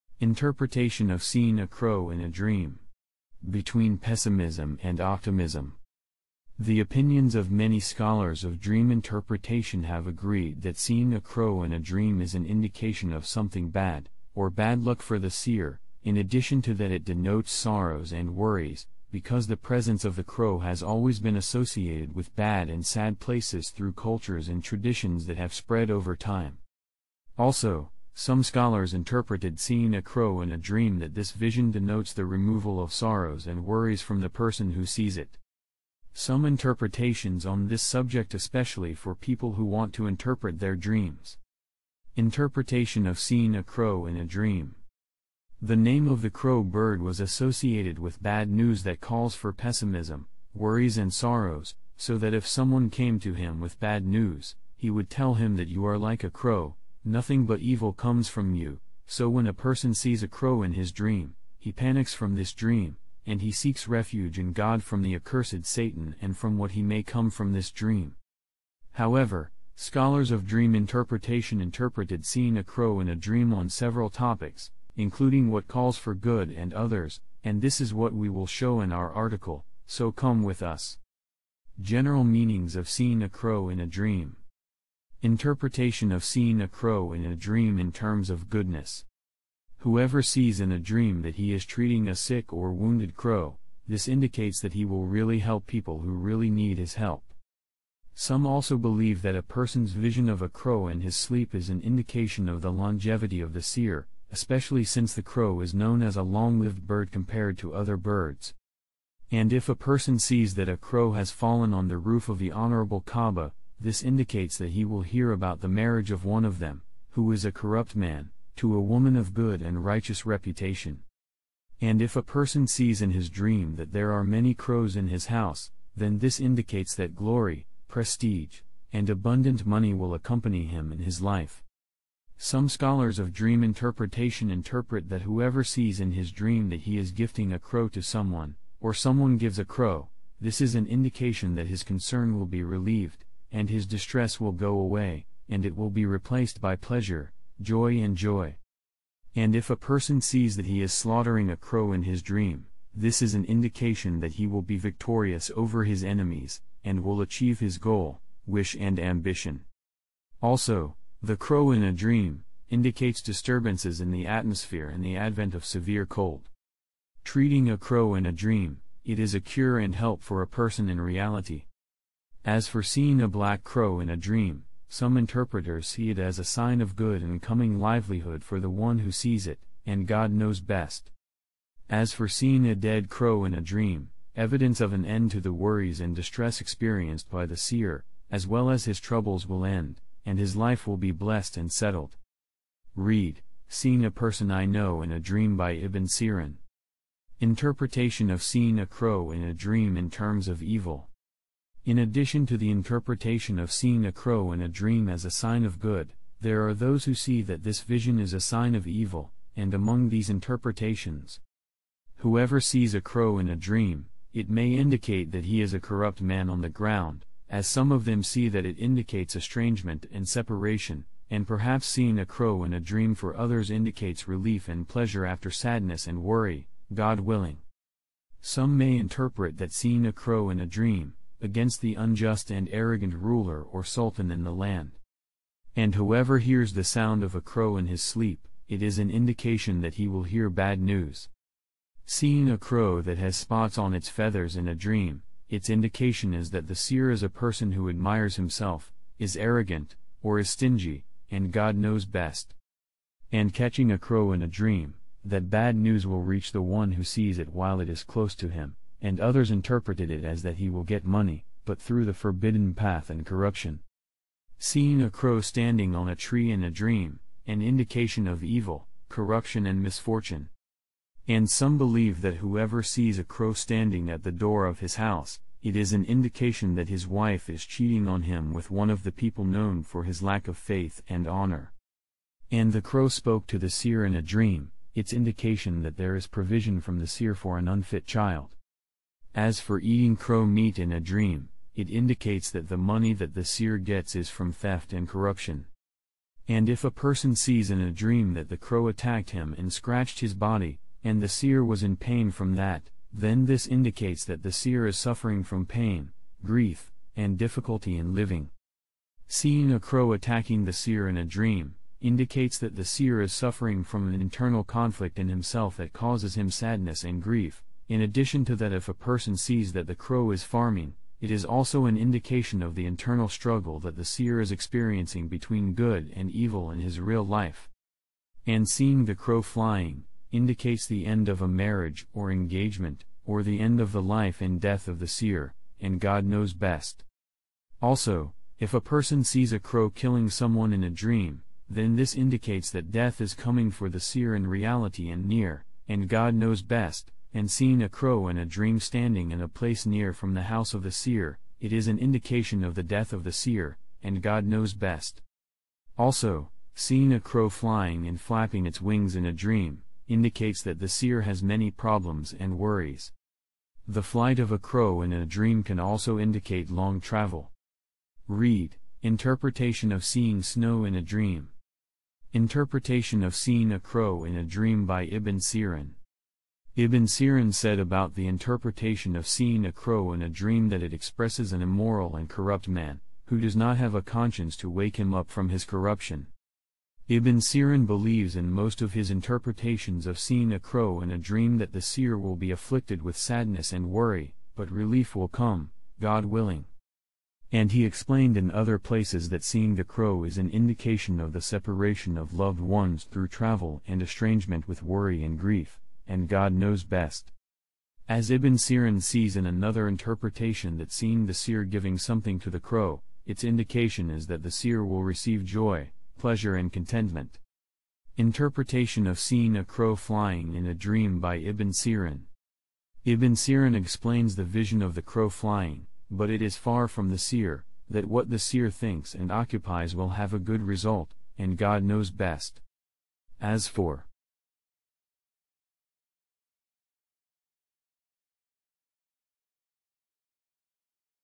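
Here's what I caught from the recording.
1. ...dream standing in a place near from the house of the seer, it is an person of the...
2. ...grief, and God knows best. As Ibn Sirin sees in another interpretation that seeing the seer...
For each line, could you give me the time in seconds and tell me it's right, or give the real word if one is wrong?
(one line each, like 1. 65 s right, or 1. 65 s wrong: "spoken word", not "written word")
1. 348 s wrong: "indication", not "person"
2. 405 s right.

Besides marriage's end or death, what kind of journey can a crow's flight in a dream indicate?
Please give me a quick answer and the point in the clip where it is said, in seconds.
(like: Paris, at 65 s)
Long travel, at 366 s.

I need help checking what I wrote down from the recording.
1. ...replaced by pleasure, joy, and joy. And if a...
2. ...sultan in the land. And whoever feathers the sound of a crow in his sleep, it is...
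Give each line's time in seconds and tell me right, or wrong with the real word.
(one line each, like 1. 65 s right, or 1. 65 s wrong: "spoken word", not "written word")
1. 146 s right
2. 233 s wrong: "hears", not "feathers".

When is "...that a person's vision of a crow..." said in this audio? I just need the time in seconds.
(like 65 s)
99 s.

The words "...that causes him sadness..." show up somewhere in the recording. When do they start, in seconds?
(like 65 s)
315 s.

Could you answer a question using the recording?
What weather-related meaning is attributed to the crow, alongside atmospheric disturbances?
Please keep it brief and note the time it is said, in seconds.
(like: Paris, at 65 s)
Severe cold, at 165 s.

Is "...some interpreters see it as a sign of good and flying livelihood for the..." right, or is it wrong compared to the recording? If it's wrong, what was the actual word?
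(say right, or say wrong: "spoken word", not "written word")
wrong: "coming", not "flying".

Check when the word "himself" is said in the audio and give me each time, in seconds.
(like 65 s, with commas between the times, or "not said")
248 s, 315 s.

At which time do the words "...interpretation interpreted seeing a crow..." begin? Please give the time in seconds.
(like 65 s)
70 s.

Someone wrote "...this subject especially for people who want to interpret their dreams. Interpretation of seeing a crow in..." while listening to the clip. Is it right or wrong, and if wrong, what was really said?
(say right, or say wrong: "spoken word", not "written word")
right.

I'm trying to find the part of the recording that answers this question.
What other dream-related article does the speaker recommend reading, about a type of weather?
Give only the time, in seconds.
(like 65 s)
369 s.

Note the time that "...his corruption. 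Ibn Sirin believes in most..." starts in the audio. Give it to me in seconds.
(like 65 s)
385 s.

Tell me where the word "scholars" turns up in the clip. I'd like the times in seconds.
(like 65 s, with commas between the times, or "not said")
7 s, 28 s, 69 s, 132 s.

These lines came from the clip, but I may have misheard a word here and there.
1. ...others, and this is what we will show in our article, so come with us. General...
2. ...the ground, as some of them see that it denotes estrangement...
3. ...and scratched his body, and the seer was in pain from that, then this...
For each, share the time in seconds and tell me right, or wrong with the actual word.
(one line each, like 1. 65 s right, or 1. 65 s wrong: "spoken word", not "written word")
1. 76 s right
2. 216 s wrong: "indicates", not "denotes"
3. 299 s right.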